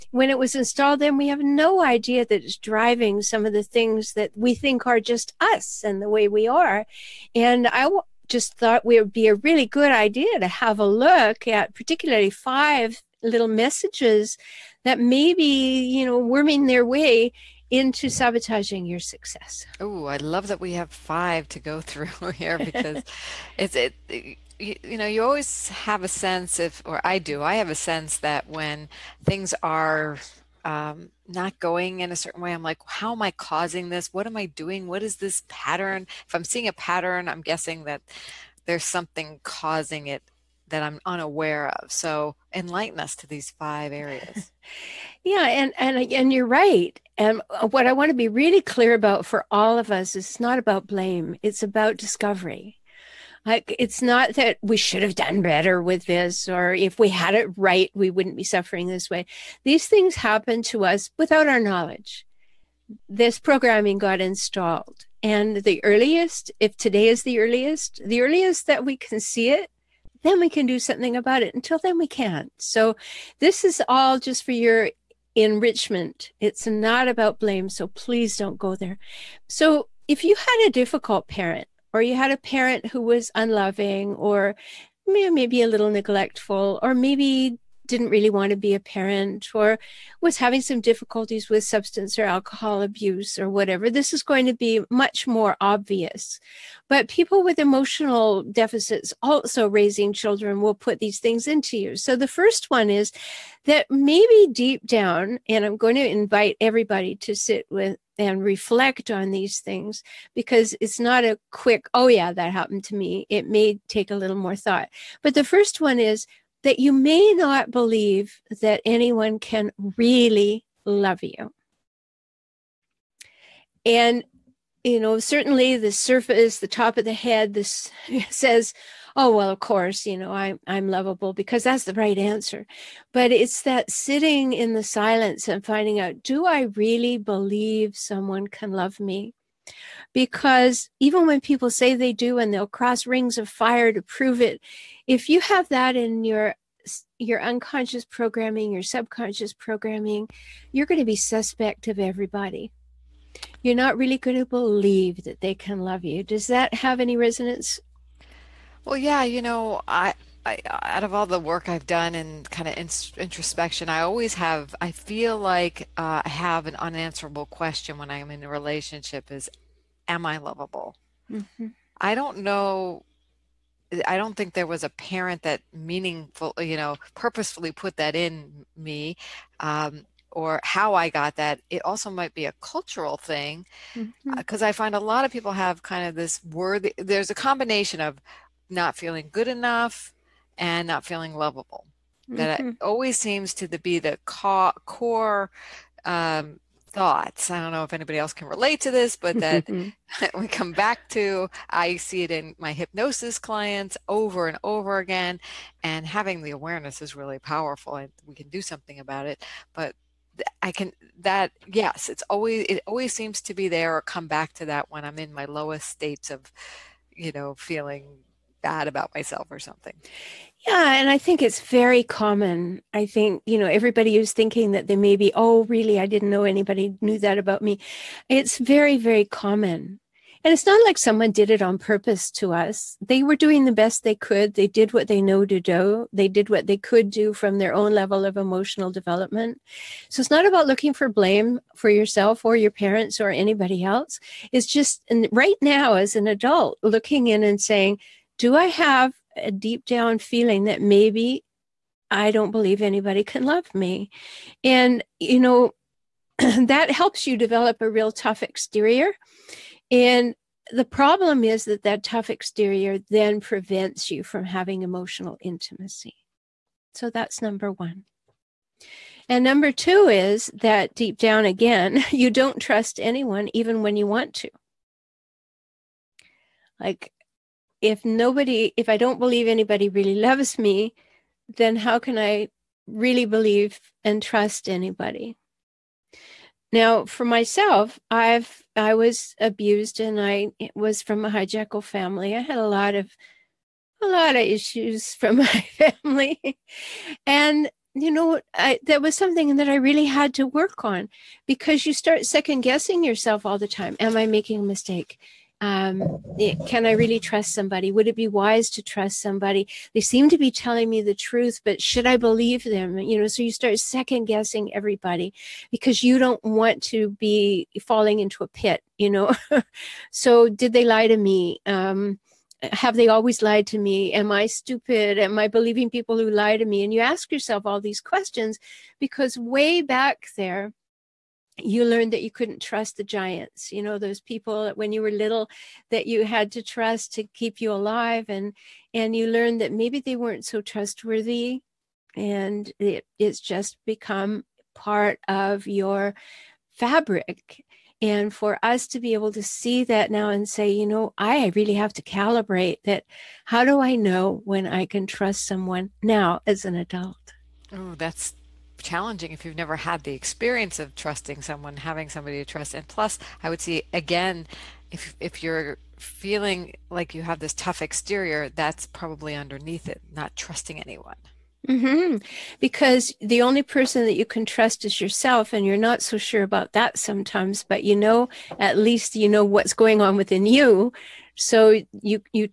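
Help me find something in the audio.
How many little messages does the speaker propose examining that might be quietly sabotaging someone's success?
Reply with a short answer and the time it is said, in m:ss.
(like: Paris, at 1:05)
5, at 0:12.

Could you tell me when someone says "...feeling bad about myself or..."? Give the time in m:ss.
3:37.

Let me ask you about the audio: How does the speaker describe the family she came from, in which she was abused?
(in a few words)
A hijackal family.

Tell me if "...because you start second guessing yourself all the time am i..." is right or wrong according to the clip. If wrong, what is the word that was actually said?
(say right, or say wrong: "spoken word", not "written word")
right.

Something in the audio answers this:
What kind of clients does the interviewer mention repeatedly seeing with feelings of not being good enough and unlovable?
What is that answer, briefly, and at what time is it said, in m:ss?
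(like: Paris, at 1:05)
Hypnosis clients, at 3:22.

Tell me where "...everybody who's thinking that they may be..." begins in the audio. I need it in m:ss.
3:43.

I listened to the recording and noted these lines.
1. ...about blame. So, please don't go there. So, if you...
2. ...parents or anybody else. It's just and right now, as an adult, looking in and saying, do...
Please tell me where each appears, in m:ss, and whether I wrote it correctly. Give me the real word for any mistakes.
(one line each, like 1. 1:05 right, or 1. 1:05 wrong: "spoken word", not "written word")
1. 1:17 right
2. 4:02 right.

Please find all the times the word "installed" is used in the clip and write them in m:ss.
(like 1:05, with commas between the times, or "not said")
0:00, 1:04.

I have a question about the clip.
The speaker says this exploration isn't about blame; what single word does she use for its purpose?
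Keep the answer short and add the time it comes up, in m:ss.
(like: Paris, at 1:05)
Discovery, at 0:51.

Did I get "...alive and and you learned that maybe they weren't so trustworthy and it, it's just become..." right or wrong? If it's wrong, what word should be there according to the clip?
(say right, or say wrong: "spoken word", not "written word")
right.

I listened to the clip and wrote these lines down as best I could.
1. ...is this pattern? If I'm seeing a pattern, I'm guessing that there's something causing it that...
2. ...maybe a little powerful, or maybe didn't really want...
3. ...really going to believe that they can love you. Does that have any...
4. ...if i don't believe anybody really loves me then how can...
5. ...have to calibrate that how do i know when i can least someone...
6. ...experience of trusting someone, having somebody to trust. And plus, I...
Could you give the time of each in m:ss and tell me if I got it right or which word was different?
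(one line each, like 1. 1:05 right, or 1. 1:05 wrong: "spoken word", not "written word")
1. 0:35 right
2. 1:25 wrong: "neglectful", not "powerful"
3. 2:33 right
4. 4:38 right
5. 5:51 wrong: "trust", not "least"
6. 6:00 right.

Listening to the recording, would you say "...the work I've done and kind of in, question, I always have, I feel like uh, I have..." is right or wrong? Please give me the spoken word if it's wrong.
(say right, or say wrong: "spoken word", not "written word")
wrong: "introspection", not "question".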